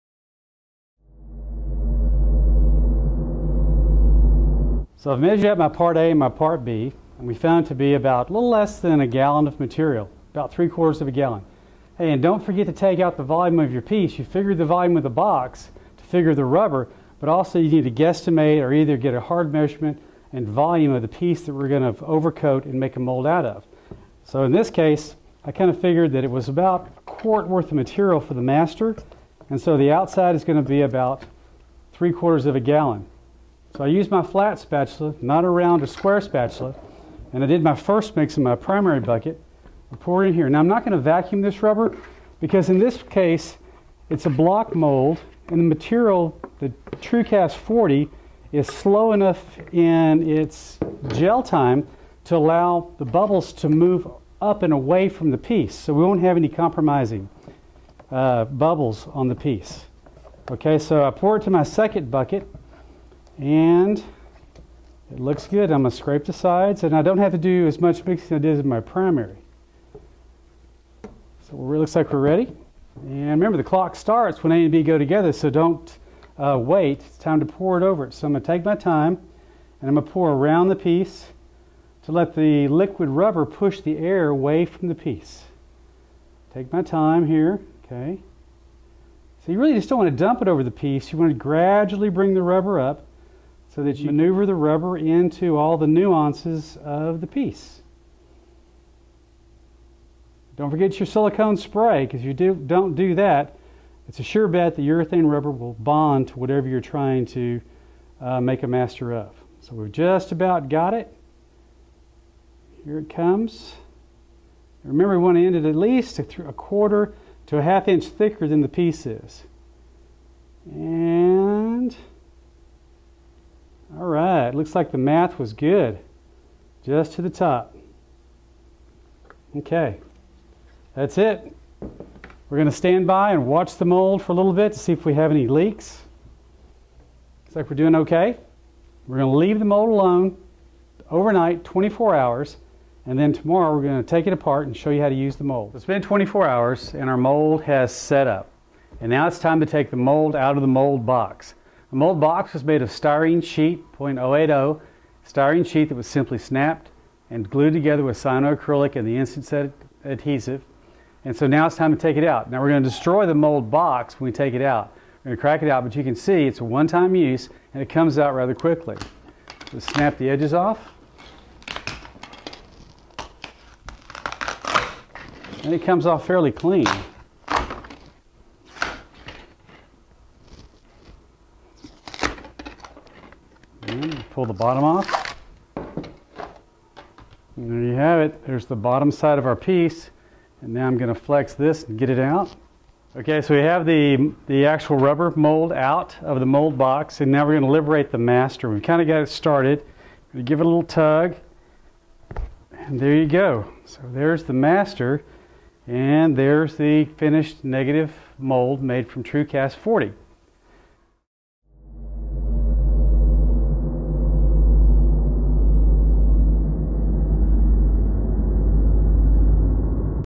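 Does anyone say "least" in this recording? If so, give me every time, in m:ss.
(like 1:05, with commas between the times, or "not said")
1:55.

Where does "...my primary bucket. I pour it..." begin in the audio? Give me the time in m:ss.
0:38.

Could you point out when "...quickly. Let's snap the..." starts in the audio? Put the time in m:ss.
2:48.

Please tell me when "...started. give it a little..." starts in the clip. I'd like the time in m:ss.
3:19.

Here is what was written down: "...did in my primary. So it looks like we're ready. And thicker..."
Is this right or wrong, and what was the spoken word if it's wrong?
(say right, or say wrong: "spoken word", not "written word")
wrong: "remember", not "thicker".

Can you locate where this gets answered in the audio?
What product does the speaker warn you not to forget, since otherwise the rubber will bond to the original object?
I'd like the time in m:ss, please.
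1:41.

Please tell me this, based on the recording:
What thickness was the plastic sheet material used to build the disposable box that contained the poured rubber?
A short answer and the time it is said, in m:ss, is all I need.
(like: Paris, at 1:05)
.080, at 2:33.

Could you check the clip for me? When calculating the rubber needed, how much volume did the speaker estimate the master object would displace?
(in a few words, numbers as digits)
a quart.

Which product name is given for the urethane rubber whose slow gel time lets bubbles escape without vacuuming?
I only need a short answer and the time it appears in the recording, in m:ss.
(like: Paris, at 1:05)
TrueCast 40, at 0:46.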